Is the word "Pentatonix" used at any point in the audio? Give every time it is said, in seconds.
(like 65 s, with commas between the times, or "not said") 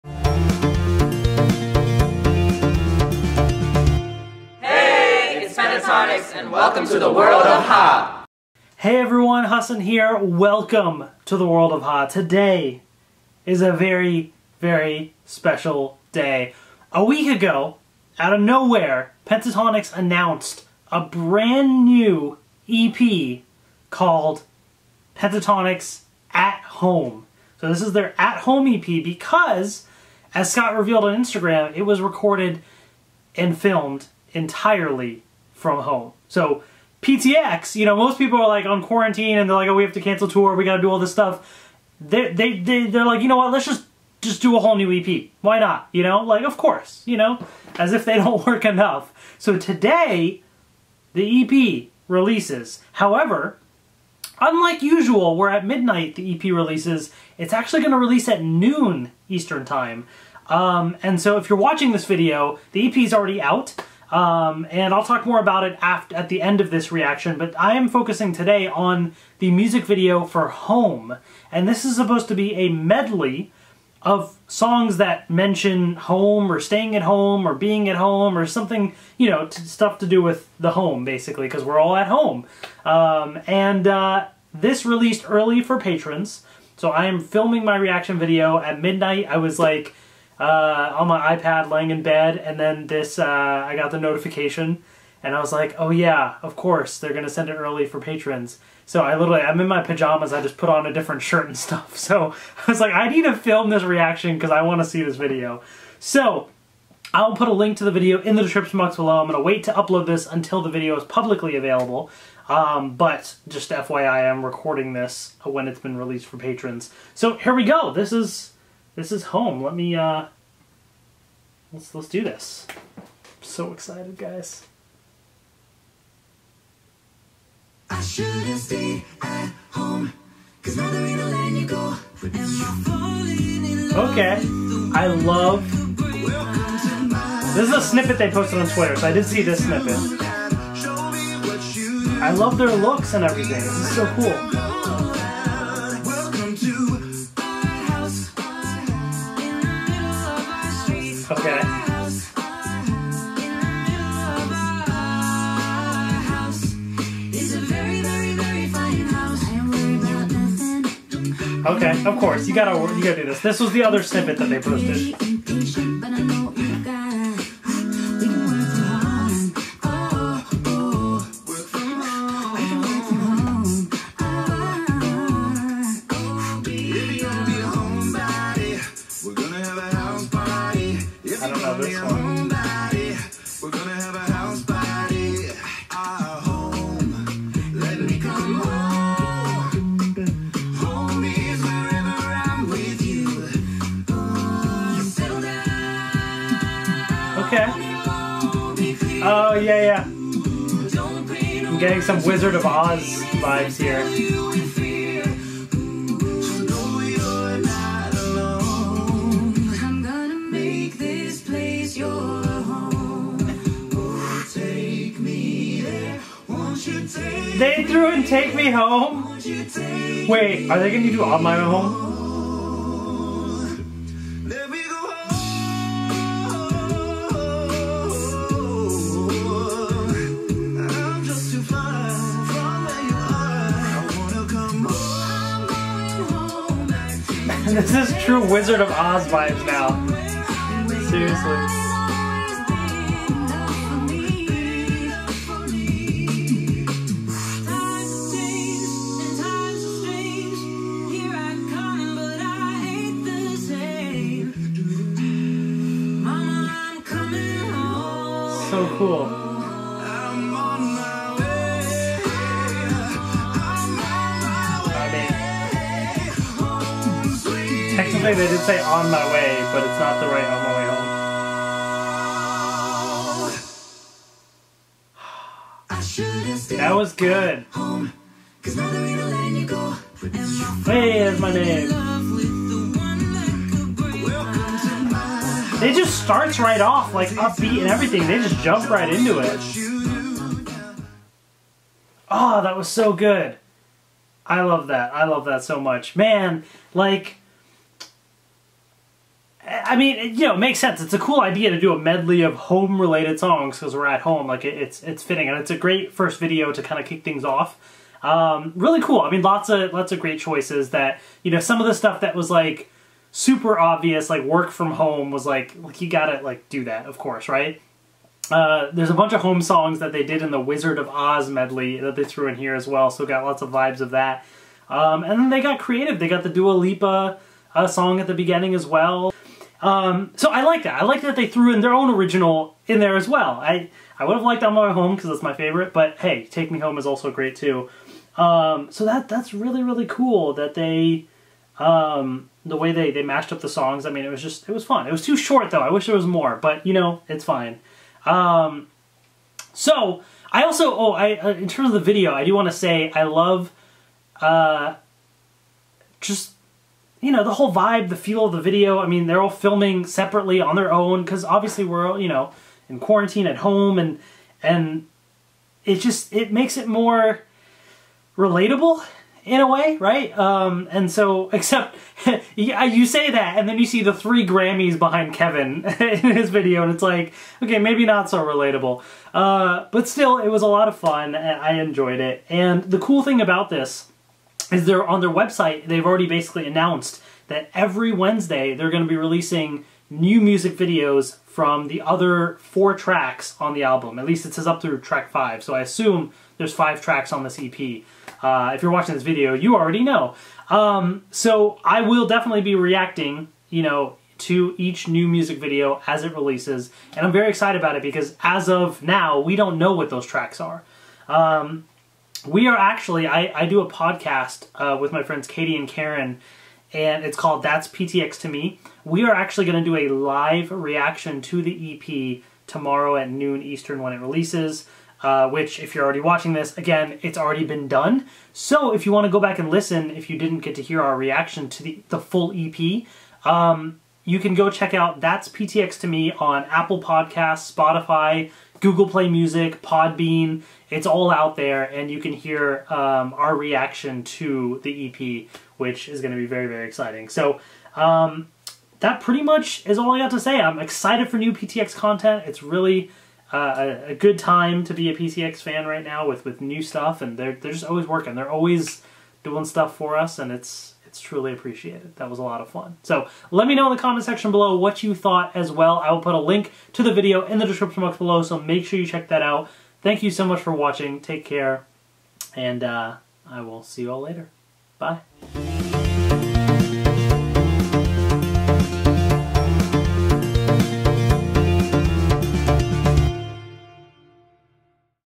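19 s, 25 s.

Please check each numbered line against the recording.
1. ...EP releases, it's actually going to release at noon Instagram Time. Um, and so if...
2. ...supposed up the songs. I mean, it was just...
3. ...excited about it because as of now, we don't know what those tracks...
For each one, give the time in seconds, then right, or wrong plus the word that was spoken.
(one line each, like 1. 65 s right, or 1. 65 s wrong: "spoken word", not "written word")
1. 56 s wrong: "Eastern", not "Instagram"
2. 343 s wrong: "mashed", not "supposed"
3. 407 s right.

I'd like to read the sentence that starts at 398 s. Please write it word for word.
Uh, if you're watching this video, you already know.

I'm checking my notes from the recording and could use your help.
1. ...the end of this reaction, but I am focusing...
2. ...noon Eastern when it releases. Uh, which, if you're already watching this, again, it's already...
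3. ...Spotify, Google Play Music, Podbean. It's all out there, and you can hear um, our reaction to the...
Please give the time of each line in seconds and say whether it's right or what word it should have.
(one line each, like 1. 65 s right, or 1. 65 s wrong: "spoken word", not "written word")
1. 66 s right
2. 423 s right
3. 437 s right.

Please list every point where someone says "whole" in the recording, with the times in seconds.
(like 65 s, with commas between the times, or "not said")
44 s, 357 s.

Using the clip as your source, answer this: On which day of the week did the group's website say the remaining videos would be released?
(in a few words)
Wednesday.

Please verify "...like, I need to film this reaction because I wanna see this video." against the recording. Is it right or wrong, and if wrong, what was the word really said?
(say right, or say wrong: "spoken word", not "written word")
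right.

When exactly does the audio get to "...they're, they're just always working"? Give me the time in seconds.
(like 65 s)
457 s.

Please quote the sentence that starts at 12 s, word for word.
Today is a very, very special day.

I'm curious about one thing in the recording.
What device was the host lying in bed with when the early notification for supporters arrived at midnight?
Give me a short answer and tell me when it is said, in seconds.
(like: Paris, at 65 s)
iPad, at 91 s.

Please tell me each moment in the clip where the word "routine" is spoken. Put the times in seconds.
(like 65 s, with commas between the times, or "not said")
not said.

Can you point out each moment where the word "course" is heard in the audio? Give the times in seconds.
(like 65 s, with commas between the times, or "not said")
46 s, 96 s, 162 s, 317 s.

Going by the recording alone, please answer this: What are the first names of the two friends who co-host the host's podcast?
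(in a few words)
Katie and Karen.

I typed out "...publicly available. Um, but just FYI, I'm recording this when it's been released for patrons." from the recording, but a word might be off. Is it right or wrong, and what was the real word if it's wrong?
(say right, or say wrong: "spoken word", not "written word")
right.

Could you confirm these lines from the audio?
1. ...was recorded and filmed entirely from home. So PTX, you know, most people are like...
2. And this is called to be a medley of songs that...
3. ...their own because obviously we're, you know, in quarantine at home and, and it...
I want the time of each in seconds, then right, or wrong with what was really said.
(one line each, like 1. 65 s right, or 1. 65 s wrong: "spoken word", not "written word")
1. 31 s right
2. 71 s wrong: "supposed", not "called"
3. 360 s right.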